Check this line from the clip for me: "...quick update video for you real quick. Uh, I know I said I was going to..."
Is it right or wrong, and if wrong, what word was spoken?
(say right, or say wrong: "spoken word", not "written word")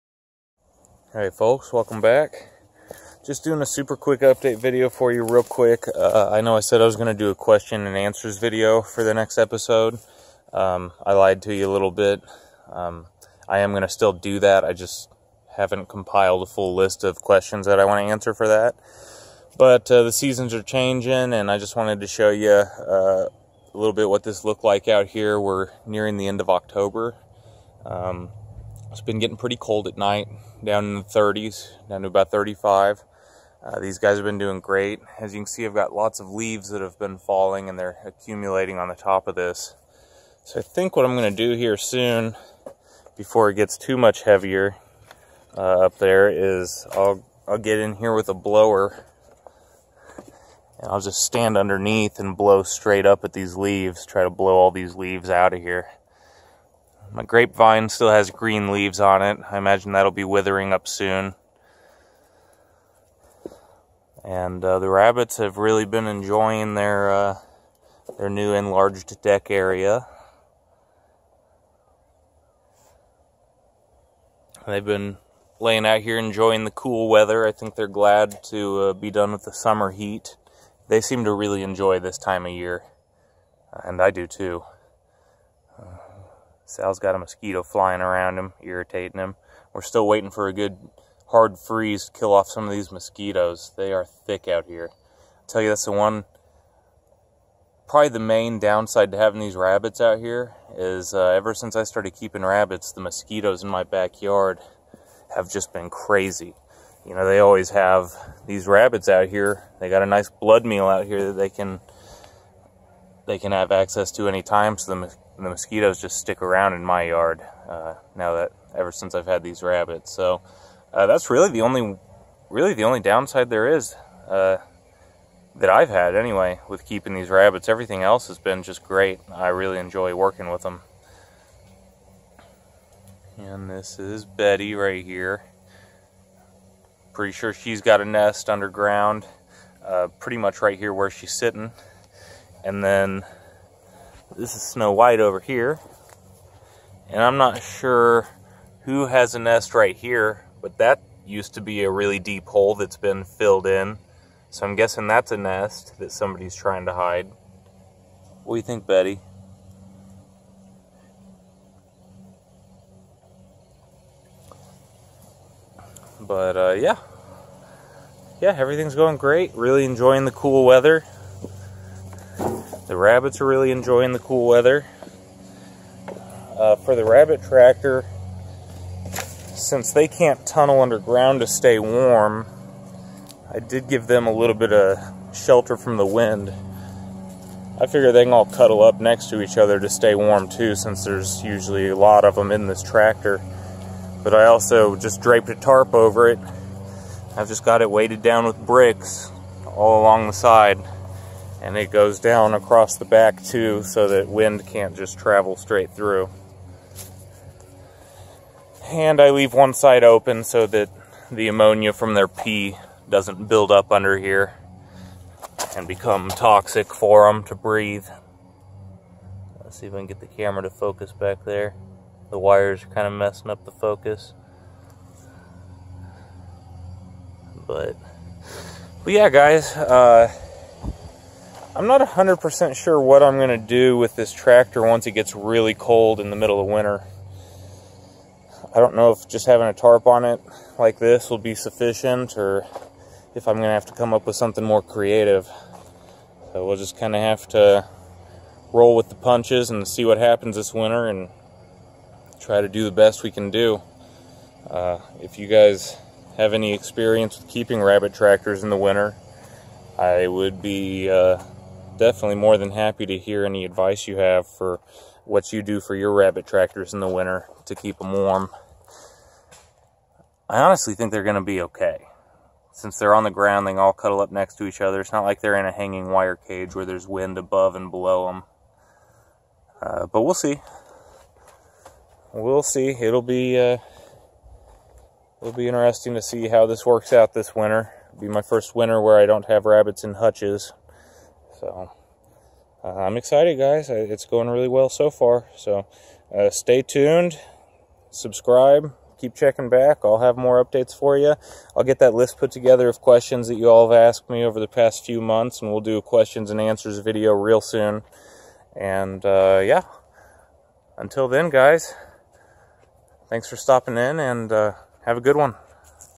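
right.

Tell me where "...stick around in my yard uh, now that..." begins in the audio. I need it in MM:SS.
01:56.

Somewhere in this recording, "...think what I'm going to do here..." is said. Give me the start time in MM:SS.
00:40.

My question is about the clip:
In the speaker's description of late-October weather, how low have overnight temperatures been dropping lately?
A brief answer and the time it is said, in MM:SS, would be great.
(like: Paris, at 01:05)
35, at 00:32.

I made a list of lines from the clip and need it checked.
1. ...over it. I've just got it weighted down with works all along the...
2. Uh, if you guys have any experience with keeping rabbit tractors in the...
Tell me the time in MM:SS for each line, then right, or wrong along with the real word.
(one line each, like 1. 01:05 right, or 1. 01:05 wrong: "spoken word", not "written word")
1. 03:15 wrong: "bricks", not "works"
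2. 04:14 right.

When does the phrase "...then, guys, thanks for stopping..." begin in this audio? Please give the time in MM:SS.
05:11.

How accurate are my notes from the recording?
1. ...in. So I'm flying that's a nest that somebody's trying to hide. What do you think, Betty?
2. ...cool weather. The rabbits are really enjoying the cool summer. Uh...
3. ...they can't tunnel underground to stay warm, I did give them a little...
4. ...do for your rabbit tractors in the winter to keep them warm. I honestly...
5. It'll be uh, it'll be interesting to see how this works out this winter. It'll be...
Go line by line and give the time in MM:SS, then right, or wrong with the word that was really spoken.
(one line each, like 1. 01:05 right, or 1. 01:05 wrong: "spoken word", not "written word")
1. 02:33 wrong: "guessing", not "flying"
2. 02:50 wrong: "weather", not "summer"
3. 02:59 right
4. 04:25 right
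5. 04:42 right.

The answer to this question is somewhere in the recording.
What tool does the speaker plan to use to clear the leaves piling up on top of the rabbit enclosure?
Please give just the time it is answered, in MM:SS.
00:48.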